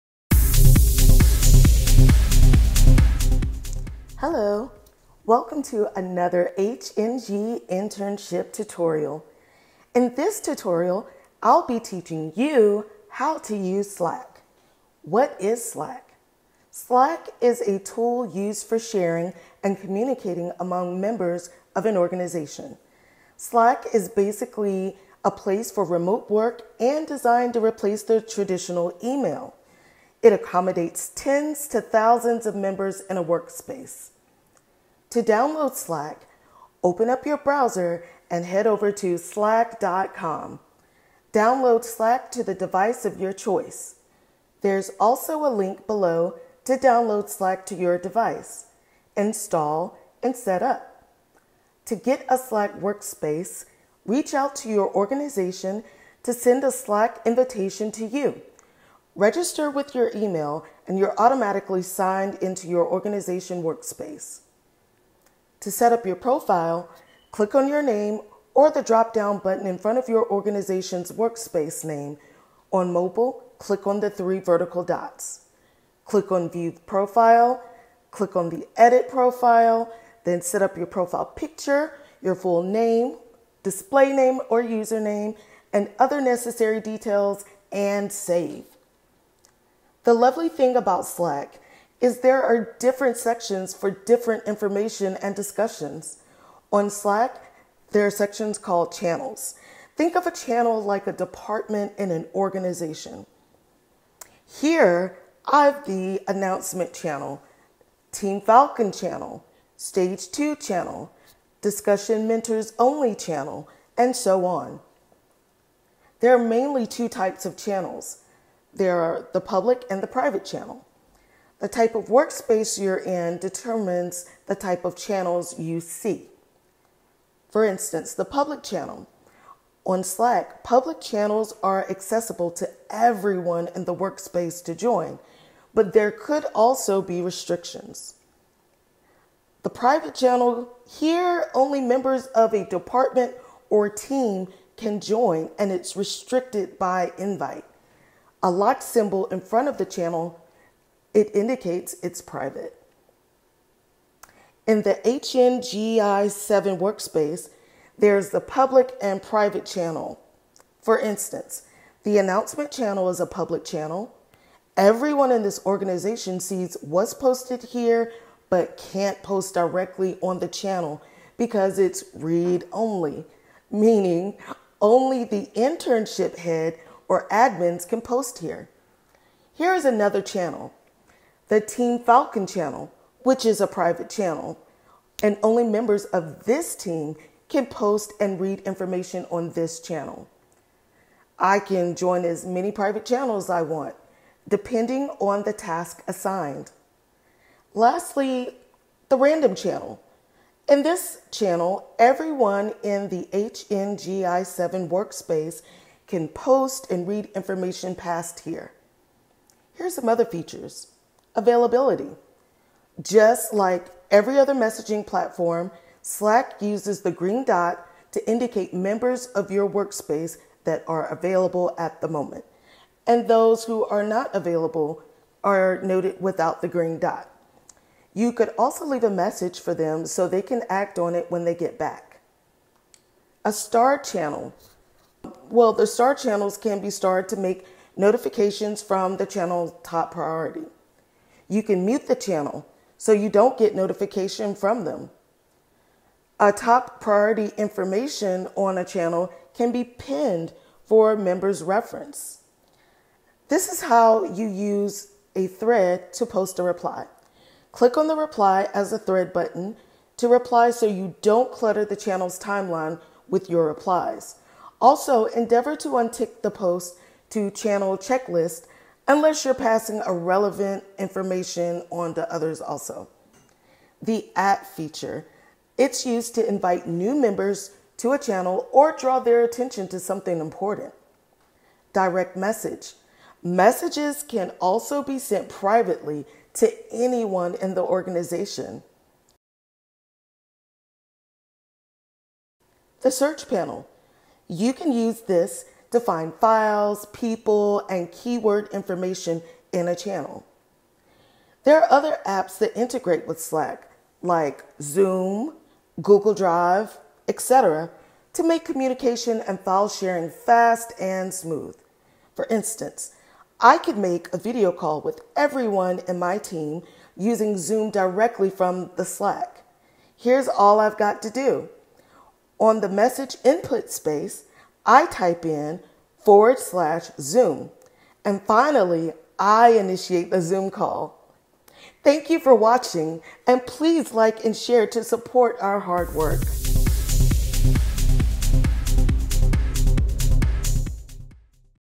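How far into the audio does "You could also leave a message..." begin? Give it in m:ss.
3:48.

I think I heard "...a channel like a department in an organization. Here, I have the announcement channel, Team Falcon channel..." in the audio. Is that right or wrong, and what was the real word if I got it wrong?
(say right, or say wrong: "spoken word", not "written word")
right.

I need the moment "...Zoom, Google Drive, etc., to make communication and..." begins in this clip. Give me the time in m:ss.
5:04.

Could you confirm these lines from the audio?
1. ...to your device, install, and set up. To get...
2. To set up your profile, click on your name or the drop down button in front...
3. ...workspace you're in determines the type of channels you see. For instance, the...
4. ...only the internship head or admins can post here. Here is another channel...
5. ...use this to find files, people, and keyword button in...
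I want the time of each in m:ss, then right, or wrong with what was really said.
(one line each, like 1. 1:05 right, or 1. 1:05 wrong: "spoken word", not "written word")
1. 0:47 right
2. 1:05 right
3. 2:02 right
4. 2:54 right
5. 4:54 wrong: "information", not "button".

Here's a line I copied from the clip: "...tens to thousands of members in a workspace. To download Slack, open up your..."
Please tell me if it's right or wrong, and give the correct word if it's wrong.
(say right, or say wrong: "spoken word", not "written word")
right.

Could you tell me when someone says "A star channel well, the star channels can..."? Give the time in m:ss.
3:53.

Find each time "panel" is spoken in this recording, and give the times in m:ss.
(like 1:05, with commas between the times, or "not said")
4:53.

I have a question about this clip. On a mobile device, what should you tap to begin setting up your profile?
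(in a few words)
three vertical dots.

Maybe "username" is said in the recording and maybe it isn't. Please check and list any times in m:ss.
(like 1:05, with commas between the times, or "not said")
1:24.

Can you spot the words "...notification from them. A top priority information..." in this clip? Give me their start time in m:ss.
4:03.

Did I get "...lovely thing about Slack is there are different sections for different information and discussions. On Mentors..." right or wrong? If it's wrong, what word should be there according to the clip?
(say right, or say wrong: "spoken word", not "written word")
wrong: "Slack", not "Mentors".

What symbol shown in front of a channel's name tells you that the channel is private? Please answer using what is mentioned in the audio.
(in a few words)
lock symbol.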